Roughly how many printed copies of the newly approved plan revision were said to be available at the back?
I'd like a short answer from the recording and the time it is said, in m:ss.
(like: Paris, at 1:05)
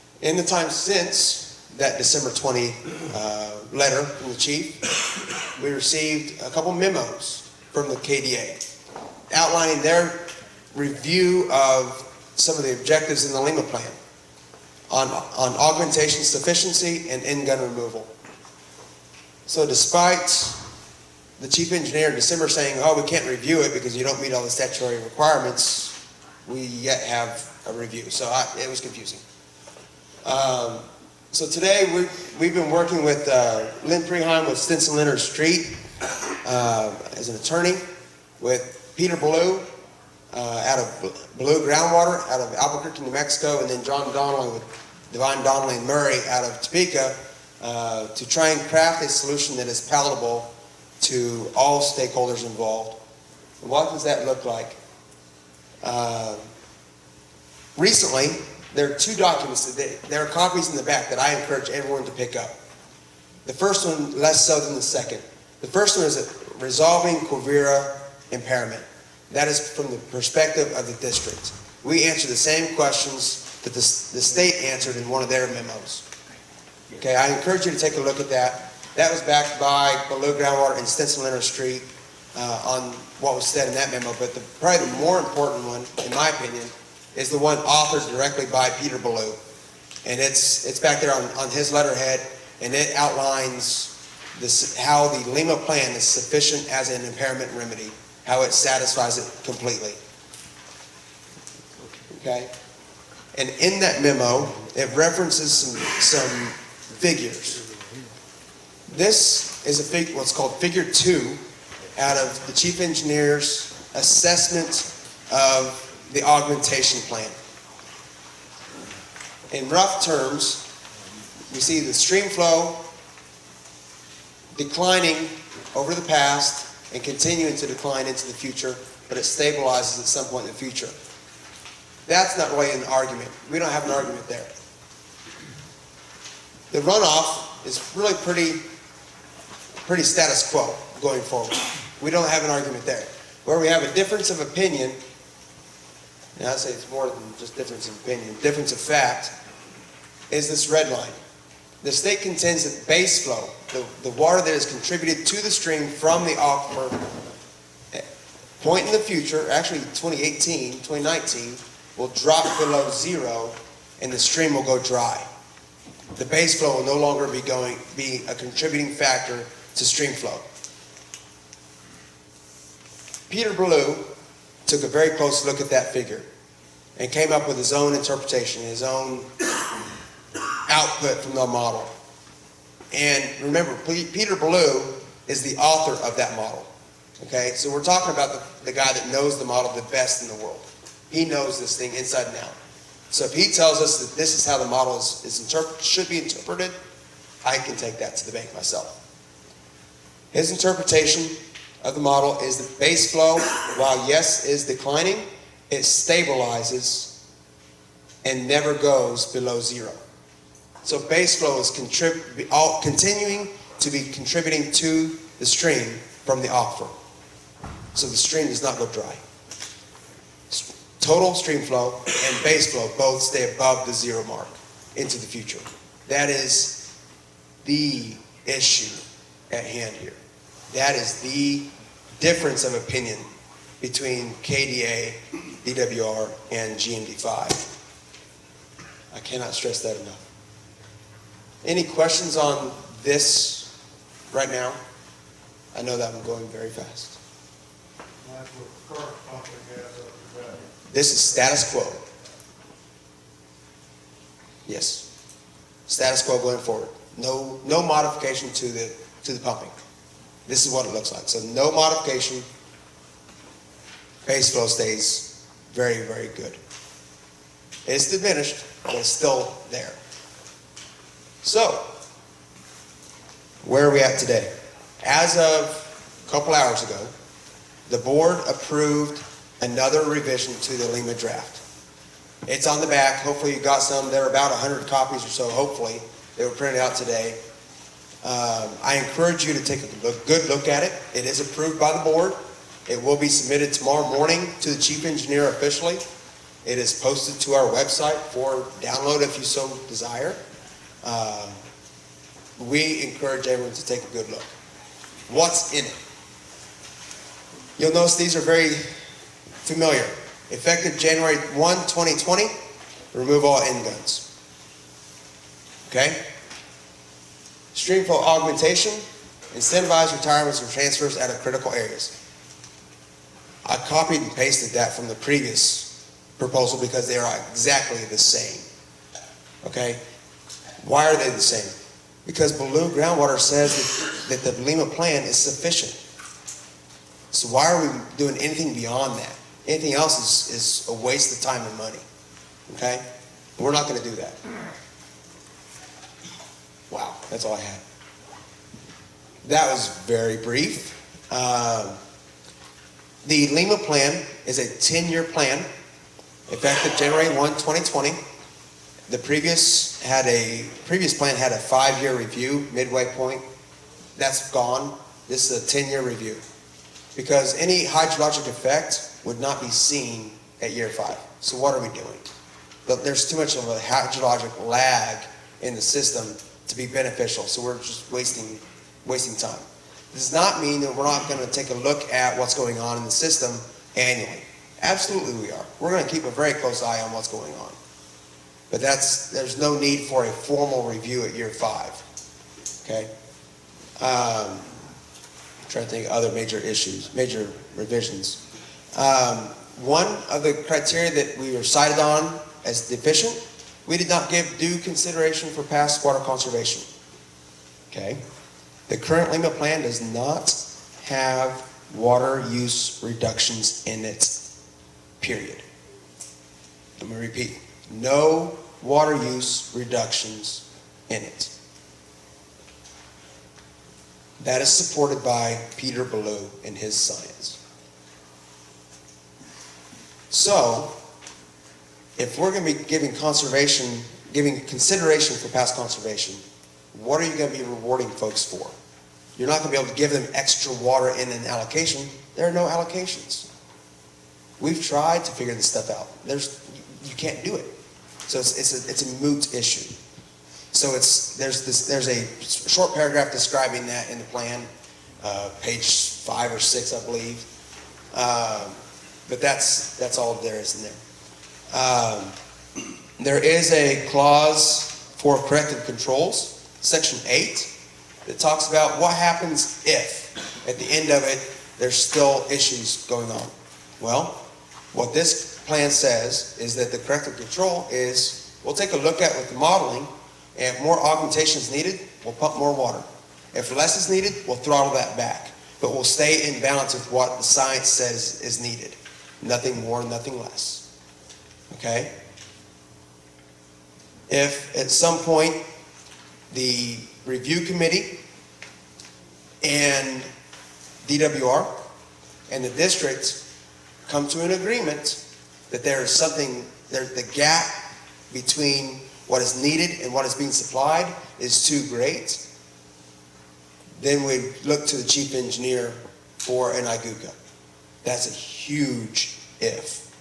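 100, at 4:44.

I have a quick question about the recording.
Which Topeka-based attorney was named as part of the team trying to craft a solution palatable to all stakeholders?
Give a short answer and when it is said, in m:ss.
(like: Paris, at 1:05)
John Donnelly, at 0:43.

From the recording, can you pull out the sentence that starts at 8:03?
If less is needed, we'll throttle that back.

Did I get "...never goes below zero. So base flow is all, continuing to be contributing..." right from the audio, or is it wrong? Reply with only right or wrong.
right.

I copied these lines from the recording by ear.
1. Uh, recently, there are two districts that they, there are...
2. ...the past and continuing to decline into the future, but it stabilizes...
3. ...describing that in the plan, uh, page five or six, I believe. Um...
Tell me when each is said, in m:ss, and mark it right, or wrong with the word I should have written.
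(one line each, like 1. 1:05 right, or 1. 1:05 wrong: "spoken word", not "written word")
1. 0:55 wrong: "documents", not "districts"
2. 2:05 right
3. 7:33 right.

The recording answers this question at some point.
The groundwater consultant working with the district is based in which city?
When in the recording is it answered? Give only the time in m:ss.
0:42.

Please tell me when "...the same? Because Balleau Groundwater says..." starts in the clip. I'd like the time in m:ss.
5:31.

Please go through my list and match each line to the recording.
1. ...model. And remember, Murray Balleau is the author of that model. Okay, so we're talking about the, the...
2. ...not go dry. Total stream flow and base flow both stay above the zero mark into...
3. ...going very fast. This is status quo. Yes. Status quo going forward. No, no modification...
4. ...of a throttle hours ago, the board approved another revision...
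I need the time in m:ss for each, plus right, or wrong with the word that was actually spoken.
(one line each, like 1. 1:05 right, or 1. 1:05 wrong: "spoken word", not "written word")
1. 3:01 wrong: "Peter", not "Murray"
2. 3:38 right
3. 4:06 right
4. 4:35 wrong: "couple", not "throttle".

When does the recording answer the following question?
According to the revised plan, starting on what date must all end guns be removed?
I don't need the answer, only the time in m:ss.
5:10.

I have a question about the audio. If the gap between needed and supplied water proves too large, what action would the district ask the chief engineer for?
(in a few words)
an IGUCA.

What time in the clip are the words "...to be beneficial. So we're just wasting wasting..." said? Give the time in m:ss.
6:16.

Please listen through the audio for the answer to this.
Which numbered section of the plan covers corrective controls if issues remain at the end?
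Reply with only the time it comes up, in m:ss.
7:46.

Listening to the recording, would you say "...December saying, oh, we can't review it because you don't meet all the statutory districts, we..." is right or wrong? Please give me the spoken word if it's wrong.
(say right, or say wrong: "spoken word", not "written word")
wrong: "requirements", not "districts".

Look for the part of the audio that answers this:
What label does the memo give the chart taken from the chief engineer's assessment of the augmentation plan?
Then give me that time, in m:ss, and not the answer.
1:50.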